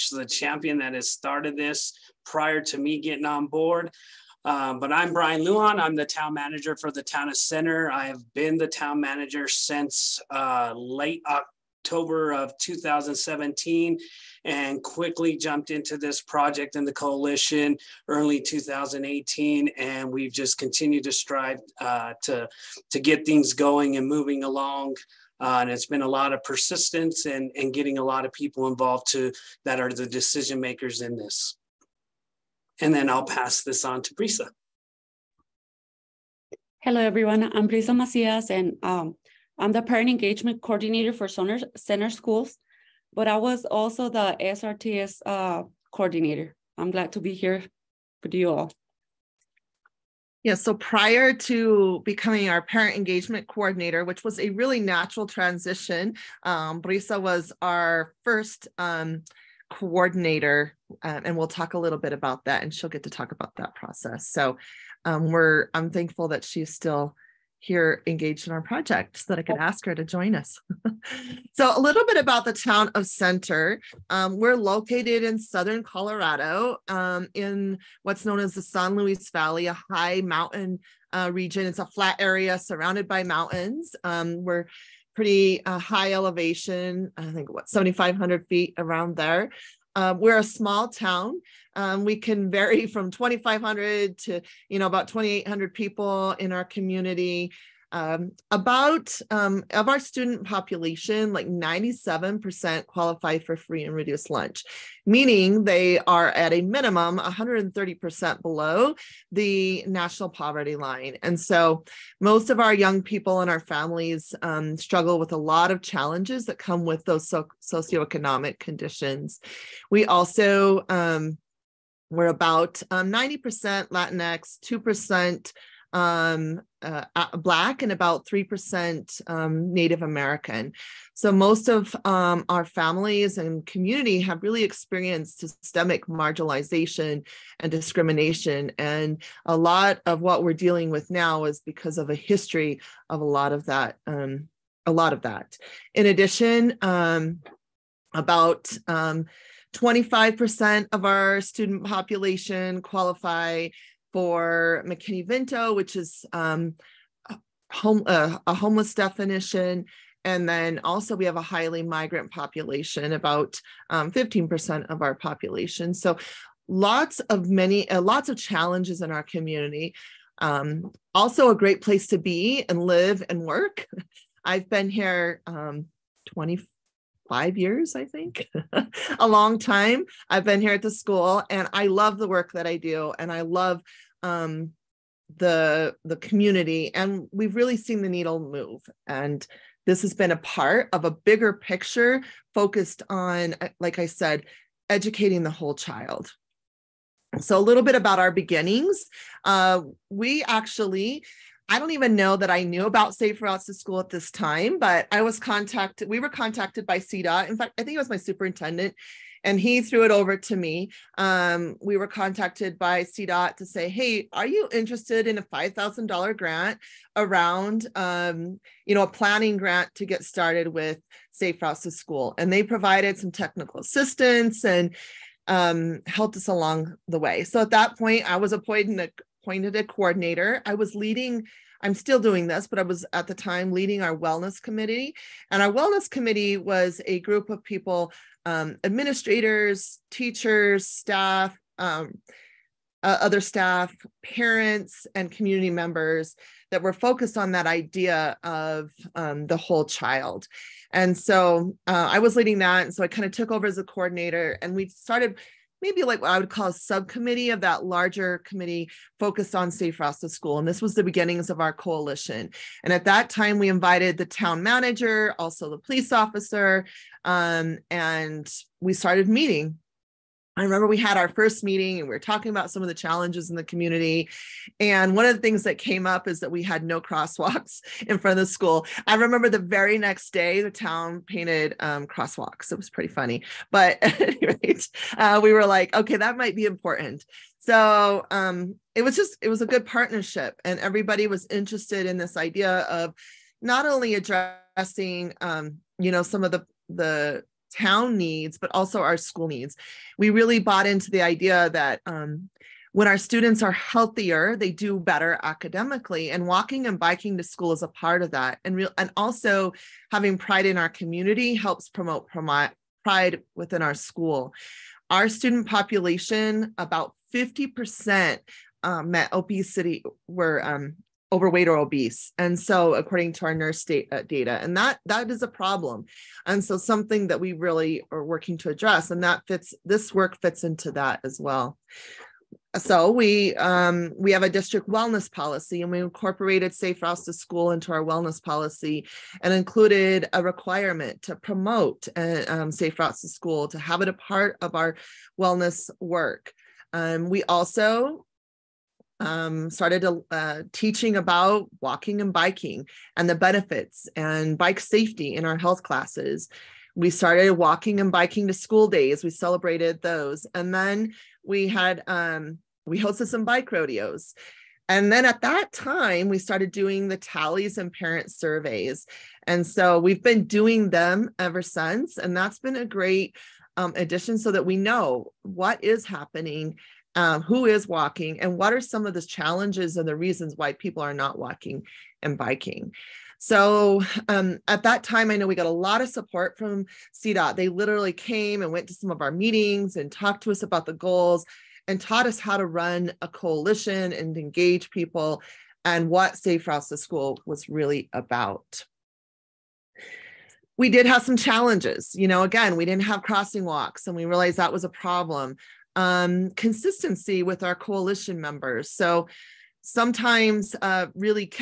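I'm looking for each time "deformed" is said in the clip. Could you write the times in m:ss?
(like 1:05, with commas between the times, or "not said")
not said.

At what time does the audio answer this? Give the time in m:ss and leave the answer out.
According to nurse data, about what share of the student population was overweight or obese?
5:17.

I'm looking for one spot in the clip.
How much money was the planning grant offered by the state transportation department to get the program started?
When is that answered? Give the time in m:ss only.
3:35.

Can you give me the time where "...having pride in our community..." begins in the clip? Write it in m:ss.
5:10.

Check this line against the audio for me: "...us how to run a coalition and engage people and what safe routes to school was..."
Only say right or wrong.
right.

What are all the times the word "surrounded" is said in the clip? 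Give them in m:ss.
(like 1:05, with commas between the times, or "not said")
1:22.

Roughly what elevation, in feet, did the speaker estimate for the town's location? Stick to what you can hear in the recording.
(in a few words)
7,500 feet.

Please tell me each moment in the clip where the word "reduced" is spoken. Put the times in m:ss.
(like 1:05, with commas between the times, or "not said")
1:43.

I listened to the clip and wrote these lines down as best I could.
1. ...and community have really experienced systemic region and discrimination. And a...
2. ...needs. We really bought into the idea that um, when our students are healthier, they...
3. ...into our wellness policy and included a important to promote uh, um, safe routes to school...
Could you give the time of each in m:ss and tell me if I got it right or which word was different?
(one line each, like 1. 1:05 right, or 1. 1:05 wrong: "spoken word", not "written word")
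1. 2:13 wrong: "marginalization", not "region"
2. 4:59 right
3. 5:37 wrong: "requirement", not "important".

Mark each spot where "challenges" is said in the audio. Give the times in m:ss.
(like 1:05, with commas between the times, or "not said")
1:55, 2:48, 4:32, 6:19, 6:41.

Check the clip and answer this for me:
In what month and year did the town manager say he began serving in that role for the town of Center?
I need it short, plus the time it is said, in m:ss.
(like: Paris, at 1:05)
October 2017, at 0:10.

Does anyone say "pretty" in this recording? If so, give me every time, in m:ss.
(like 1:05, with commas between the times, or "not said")
1:25, 4:42.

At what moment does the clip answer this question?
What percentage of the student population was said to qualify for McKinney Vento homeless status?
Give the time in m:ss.
2:29.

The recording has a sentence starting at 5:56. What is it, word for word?
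We started walking and biking to school days.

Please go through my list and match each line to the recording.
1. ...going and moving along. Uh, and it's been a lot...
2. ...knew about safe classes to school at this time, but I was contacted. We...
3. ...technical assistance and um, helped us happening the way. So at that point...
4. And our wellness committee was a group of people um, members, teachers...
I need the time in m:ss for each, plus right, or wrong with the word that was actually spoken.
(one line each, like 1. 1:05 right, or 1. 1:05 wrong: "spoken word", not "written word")
1. 0:23 right
2. 3:22 wrong: "routes", not "classes"
3. 3:43 wrong: "along", not "happening"
4. 3:55 wrong: "administrators", not "members".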